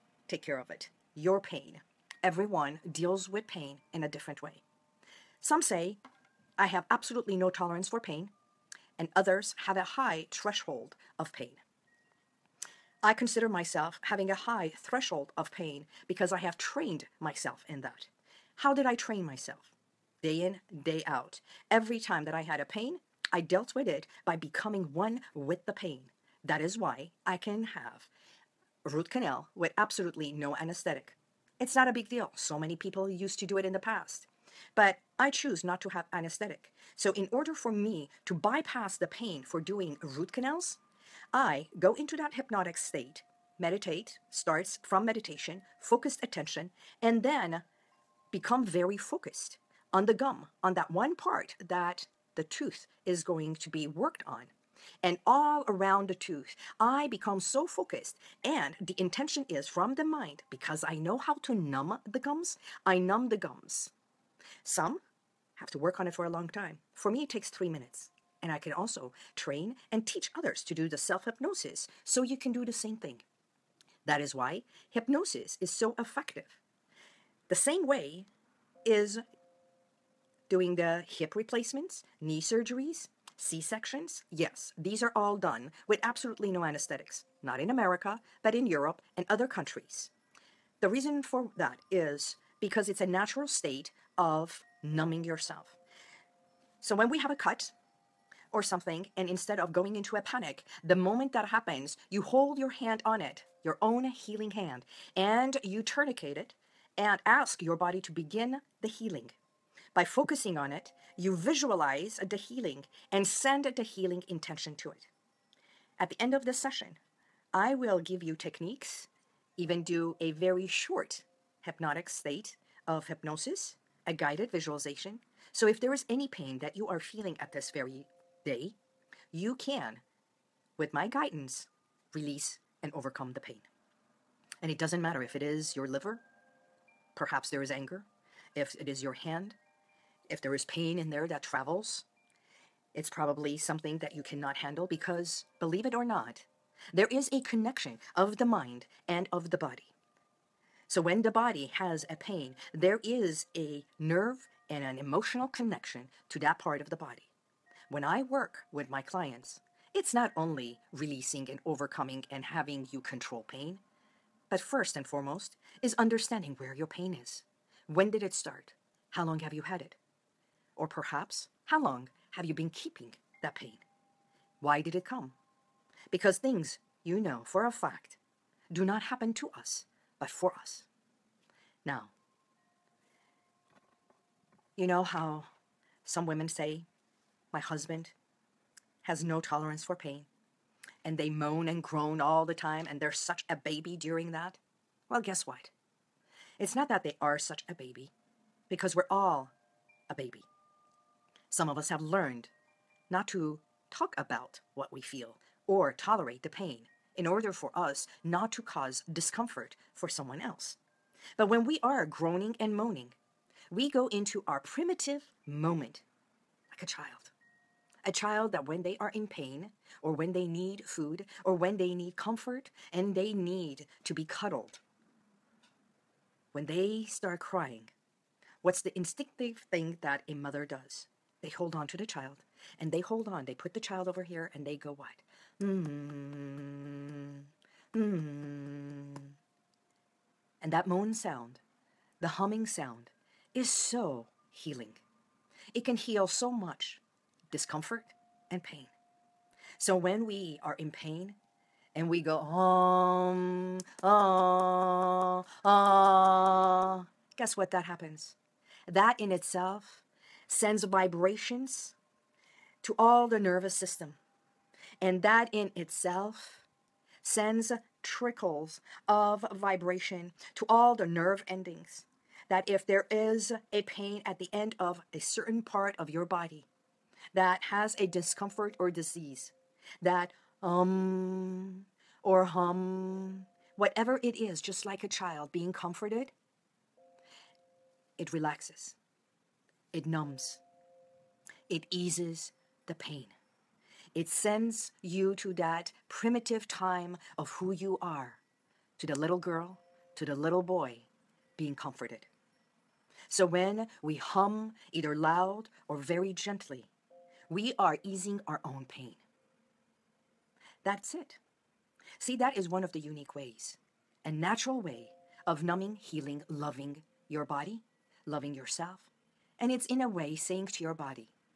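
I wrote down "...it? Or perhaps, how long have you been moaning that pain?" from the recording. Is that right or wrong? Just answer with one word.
wrong.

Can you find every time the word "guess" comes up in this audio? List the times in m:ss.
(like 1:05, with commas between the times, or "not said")
3:15, 4:17.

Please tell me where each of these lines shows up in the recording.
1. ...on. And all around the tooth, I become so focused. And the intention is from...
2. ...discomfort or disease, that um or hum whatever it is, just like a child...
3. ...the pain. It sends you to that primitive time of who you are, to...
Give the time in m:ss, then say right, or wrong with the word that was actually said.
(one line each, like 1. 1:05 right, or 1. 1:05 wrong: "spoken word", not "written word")
1. 0:54 right
2. 4:38 right
3. 4:52 right.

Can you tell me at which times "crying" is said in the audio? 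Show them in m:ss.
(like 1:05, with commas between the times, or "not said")
3:47.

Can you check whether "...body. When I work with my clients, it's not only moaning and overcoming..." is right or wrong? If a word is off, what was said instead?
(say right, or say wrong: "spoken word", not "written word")
wrong: "releasing", not "moaning".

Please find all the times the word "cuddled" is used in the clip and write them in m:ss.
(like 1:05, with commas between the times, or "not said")
3:44.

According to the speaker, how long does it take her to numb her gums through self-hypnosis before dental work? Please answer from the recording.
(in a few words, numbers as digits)
3 minutes.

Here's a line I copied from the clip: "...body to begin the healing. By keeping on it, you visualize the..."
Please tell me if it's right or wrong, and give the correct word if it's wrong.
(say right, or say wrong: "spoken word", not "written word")
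wrong: "focusing", not "keeping".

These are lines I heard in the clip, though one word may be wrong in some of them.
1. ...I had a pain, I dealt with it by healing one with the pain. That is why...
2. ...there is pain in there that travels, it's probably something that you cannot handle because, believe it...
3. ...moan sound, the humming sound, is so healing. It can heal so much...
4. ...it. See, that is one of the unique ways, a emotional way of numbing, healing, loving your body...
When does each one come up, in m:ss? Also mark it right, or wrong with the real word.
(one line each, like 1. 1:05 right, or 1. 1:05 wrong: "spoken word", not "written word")
1. 0:22 wrong: "becoming", not "healing"
2. 2:20 right
3. 4:00 right
4. 5:11 wrong: "natural", not "emotional".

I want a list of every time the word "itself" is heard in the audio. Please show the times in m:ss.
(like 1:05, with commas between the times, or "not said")
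4:19, 4:25.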